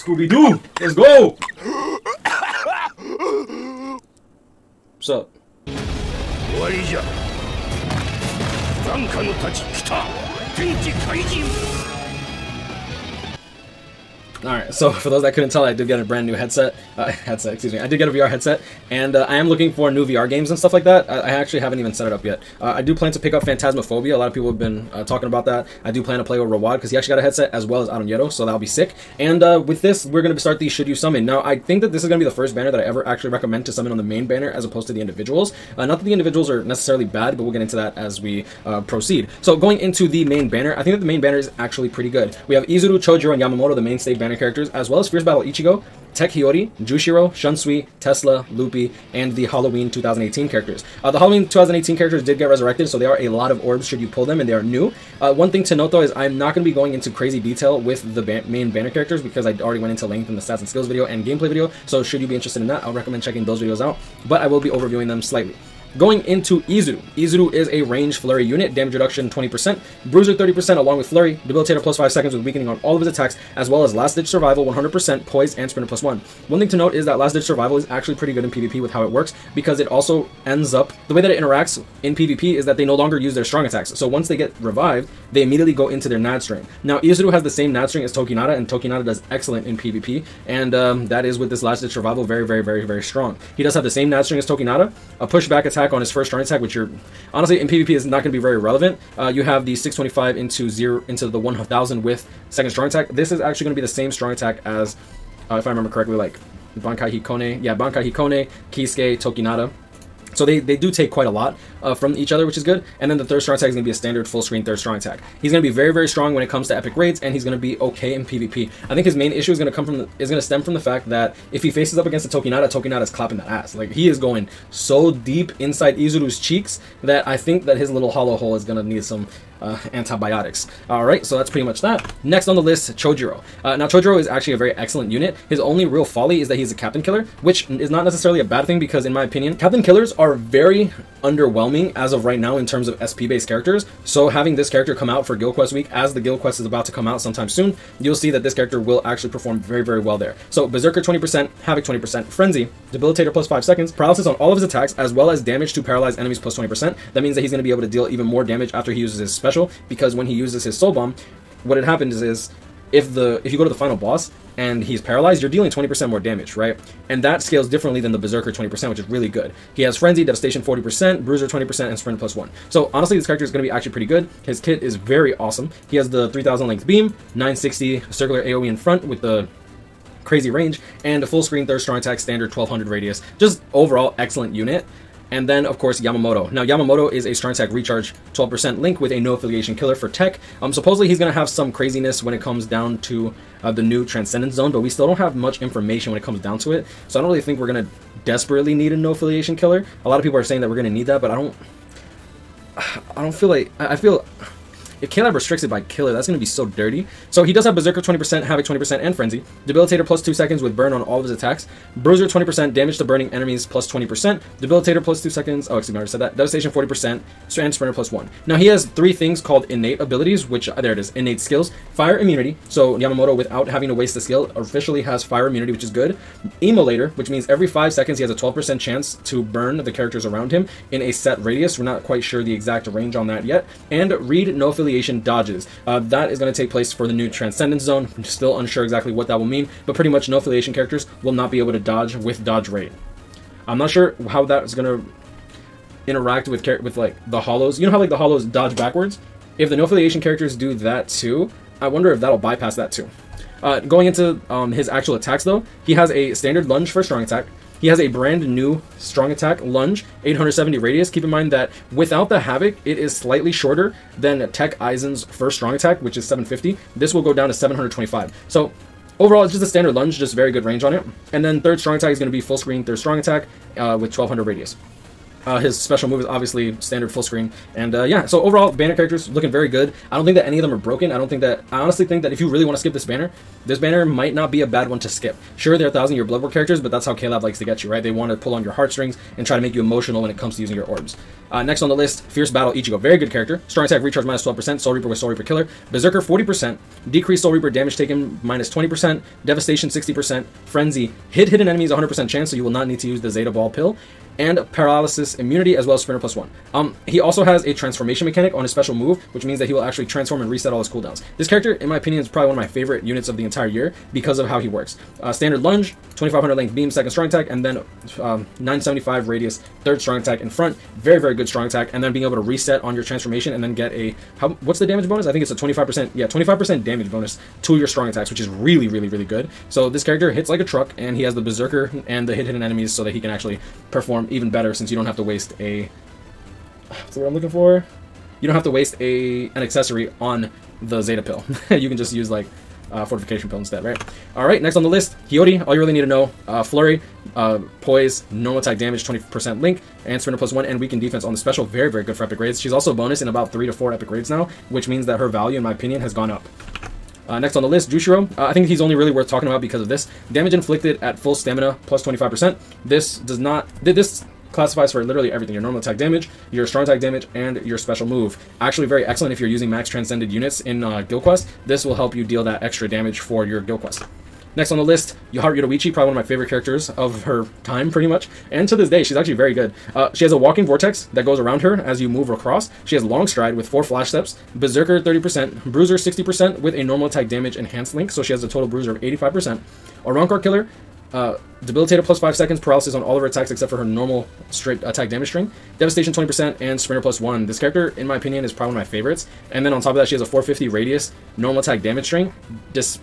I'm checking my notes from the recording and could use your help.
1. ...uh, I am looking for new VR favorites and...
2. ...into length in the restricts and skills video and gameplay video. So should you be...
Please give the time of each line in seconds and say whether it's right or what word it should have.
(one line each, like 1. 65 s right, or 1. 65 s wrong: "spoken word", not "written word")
1. 19 s wrong: "games", not "favorites"
2. 59 s wrong: "stats", not "restricts".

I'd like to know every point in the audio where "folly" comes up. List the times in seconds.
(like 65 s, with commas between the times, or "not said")
136 s.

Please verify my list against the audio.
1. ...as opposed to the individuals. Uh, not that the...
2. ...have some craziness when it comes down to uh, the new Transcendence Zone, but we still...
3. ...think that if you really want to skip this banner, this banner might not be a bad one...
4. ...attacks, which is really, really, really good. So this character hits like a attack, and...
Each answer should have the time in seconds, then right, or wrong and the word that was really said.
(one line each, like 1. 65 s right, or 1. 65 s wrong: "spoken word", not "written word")
1. 34 s right
2. 191 s right
3. 282 s right
4. 328 s wrong: "truck", not "attack".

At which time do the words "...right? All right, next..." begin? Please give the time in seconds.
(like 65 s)
343 s.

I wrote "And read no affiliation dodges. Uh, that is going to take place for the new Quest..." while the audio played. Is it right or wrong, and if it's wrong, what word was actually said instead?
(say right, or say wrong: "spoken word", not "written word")
wrong: "Transcendence", not "Quest".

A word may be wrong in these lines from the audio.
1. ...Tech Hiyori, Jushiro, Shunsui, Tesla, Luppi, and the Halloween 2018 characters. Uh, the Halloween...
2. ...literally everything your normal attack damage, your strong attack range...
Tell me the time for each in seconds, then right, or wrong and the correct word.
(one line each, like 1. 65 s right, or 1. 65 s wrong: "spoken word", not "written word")
1. 46 s right
2. 365 s wrong: "damage", not "range".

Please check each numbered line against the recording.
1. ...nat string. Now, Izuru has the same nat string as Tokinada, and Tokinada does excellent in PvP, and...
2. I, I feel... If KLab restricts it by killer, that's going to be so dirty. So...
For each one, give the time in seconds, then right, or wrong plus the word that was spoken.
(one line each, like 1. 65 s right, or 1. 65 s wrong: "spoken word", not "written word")
1. 86 s right
2. 203 s right.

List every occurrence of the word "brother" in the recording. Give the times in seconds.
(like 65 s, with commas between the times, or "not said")
not said.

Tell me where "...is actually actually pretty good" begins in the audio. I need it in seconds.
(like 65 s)
41 s.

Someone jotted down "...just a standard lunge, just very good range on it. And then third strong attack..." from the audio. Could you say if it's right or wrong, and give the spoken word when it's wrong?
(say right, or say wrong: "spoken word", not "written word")
right.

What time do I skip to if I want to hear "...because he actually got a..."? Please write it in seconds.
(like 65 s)
26 s.